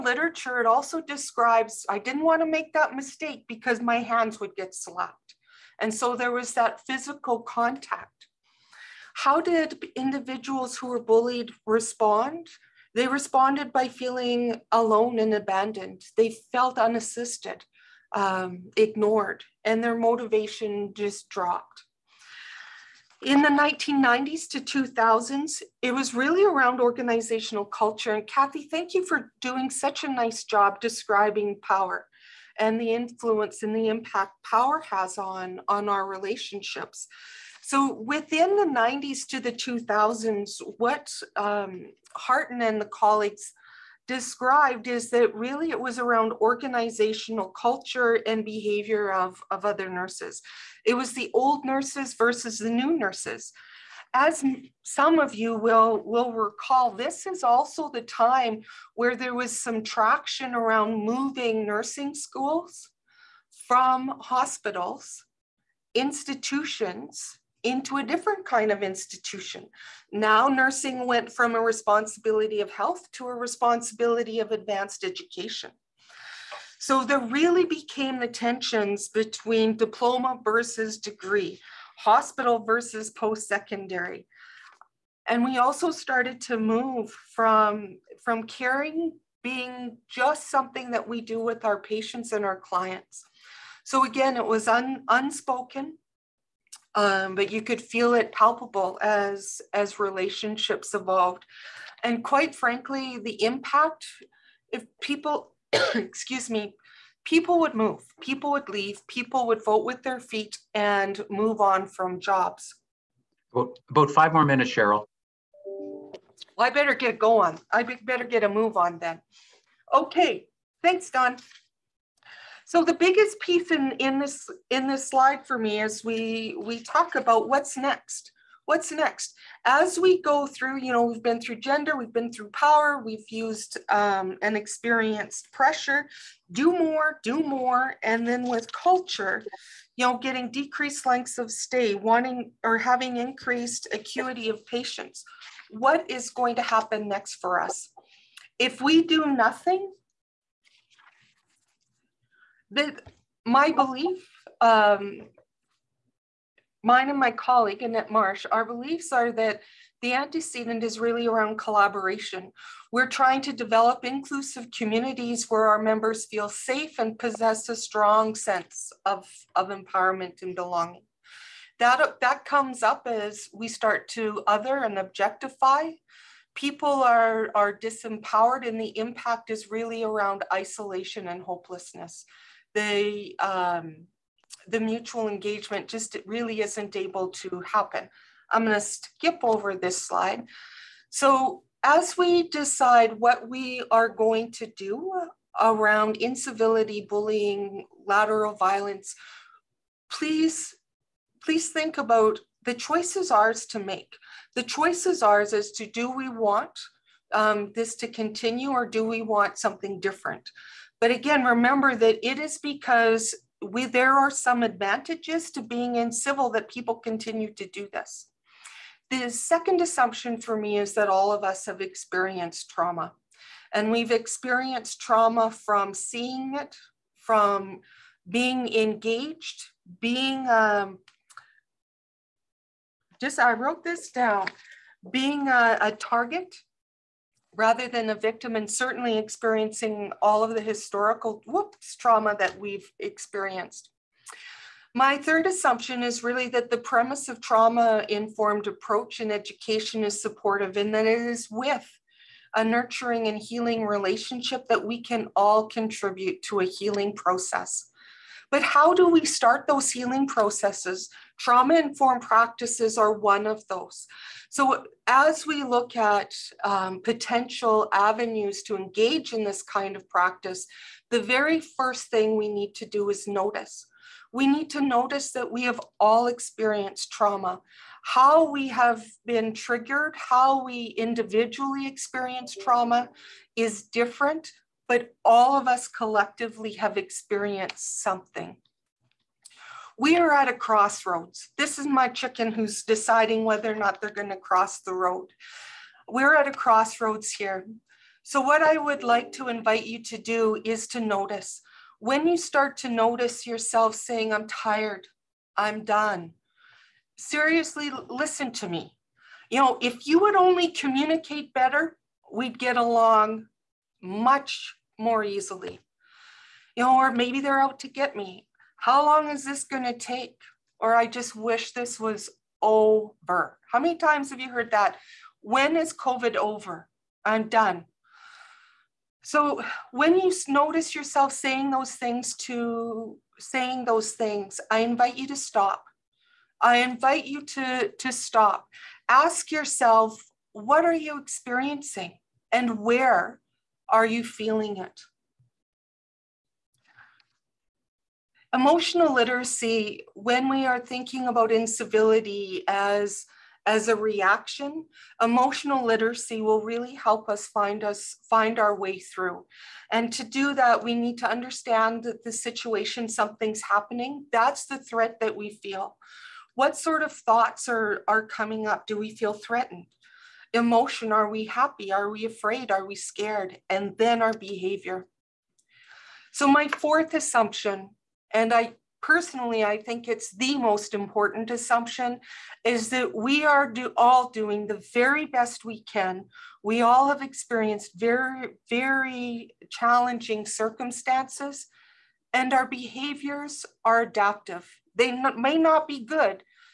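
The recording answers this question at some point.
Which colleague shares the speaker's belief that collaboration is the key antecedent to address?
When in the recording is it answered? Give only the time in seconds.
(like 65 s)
157 s.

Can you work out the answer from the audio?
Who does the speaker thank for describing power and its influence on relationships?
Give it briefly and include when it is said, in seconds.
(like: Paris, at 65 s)
Kathy, at 28 s.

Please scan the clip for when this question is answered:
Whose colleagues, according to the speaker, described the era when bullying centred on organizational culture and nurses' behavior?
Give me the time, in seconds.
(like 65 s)
42 s.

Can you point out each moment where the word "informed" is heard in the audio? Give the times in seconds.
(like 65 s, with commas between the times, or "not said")
248 s, 261 s.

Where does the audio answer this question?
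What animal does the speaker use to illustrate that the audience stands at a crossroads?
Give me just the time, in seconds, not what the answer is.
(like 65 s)
292 s.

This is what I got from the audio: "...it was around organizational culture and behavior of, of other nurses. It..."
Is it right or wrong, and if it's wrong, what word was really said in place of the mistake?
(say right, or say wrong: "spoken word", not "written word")
right.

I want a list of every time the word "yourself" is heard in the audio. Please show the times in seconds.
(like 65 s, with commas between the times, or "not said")
303 s, 330 s, 339 s.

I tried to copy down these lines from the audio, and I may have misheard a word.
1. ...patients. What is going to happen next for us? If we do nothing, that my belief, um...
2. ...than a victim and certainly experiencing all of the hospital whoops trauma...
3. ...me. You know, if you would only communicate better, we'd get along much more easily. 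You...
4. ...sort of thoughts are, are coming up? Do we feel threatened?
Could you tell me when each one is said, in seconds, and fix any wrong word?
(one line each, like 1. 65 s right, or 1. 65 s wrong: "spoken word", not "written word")
1. 144 s right
2. 237 s wrong: "historical", not "hospital"
3. 308 s right
4. 366 s right.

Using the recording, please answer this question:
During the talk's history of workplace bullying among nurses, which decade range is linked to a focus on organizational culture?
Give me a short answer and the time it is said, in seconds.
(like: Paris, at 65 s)
1990s to 2000s, at 23 s.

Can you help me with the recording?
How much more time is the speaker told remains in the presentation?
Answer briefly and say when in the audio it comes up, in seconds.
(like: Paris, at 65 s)
5 minutes, at 114 s.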